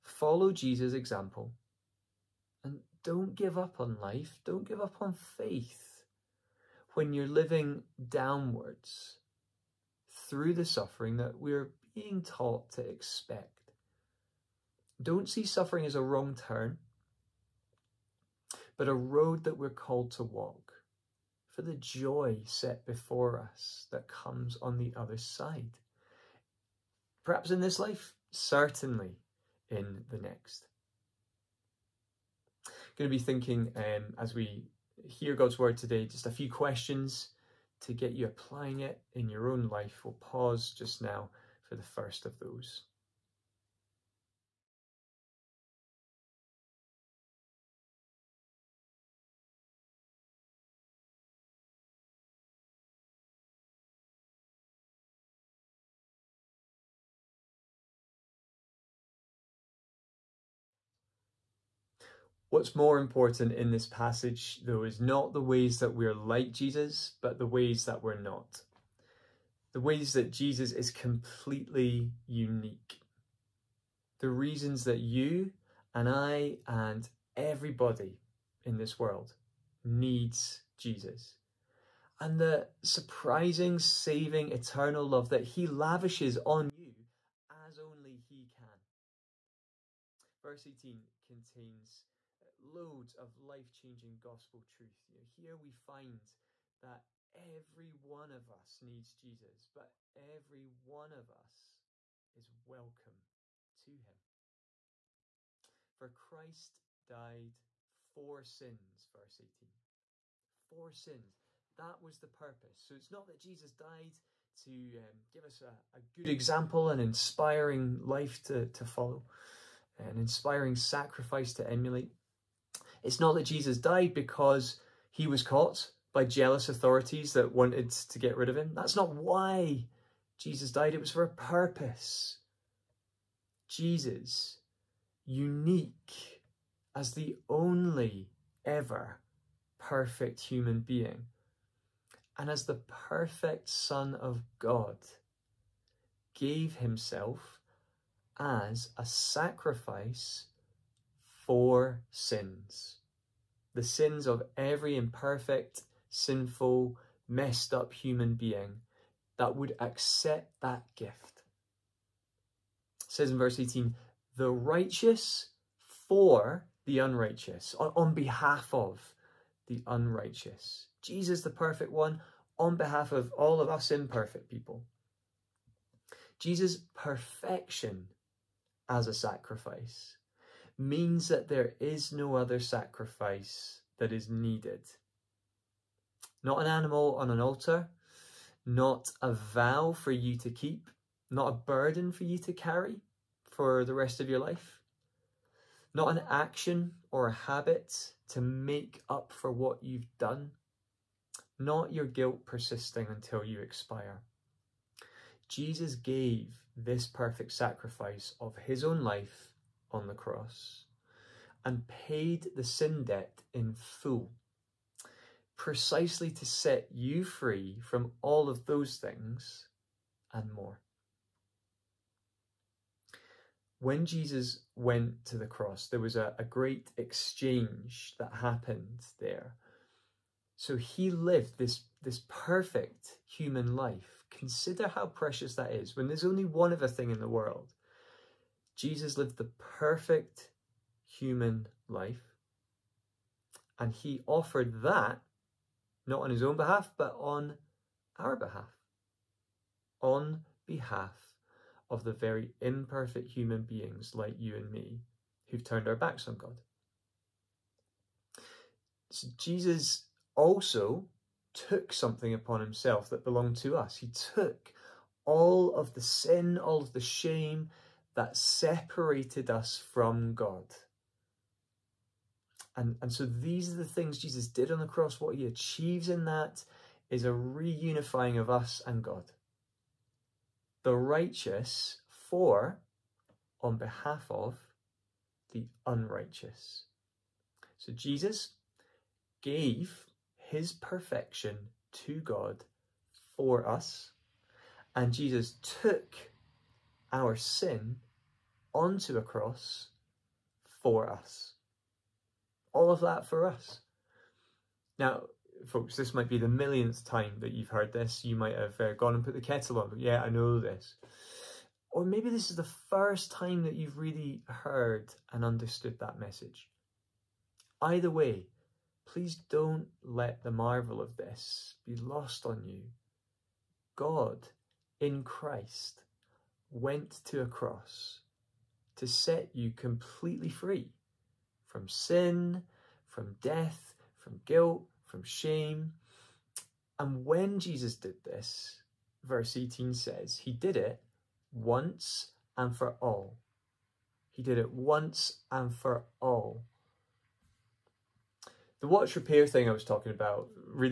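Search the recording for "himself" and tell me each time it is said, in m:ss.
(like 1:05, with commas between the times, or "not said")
2:26, 4:22.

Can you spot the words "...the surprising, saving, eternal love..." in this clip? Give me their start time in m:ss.
1:22.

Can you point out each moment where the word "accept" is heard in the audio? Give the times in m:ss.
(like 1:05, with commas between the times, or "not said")
2:39.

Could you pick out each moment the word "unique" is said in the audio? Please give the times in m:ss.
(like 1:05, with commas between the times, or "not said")
1:12, 2:15.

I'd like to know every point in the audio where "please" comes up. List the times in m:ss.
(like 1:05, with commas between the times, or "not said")
5:19.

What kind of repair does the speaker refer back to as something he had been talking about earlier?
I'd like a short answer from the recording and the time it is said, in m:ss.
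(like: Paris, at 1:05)
watch repair, at 5:48.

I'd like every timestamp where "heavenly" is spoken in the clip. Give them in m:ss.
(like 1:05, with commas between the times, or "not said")
not said.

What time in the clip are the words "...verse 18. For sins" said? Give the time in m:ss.
1:49.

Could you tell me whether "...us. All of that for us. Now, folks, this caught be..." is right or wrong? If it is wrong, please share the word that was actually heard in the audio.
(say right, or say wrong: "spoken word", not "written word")
wrong: "might", not "caught".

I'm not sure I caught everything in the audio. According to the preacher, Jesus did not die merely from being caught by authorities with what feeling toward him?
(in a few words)
jealous.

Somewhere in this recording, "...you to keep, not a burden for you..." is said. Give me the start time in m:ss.
3:10.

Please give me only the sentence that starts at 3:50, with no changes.
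So he lived this, this perfect human life.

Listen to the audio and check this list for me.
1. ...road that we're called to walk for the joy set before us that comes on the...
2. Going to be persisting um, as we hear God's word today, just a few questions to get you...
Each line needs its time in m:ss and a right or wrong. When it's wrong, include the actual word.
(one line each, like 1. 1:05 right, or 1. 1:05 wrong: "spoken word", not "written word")
1. 0:18 right
2. 0:32 wrong: "thinking", not "persisting".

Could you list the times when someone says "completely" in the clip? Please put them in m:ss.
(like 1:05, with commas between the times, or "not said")
1:10, 5:29.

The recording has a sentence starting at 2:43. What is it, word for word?
It says in verse 18, the righteous for the unrighteous, on, on behalf of the unrighteous.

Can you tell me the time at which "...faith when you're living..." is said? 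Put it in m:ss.
0:05.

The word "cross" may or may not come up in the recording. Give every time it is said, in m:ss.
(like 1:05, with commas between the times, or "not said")
3:30, 3:45, 4:34, 4:59, 5:27.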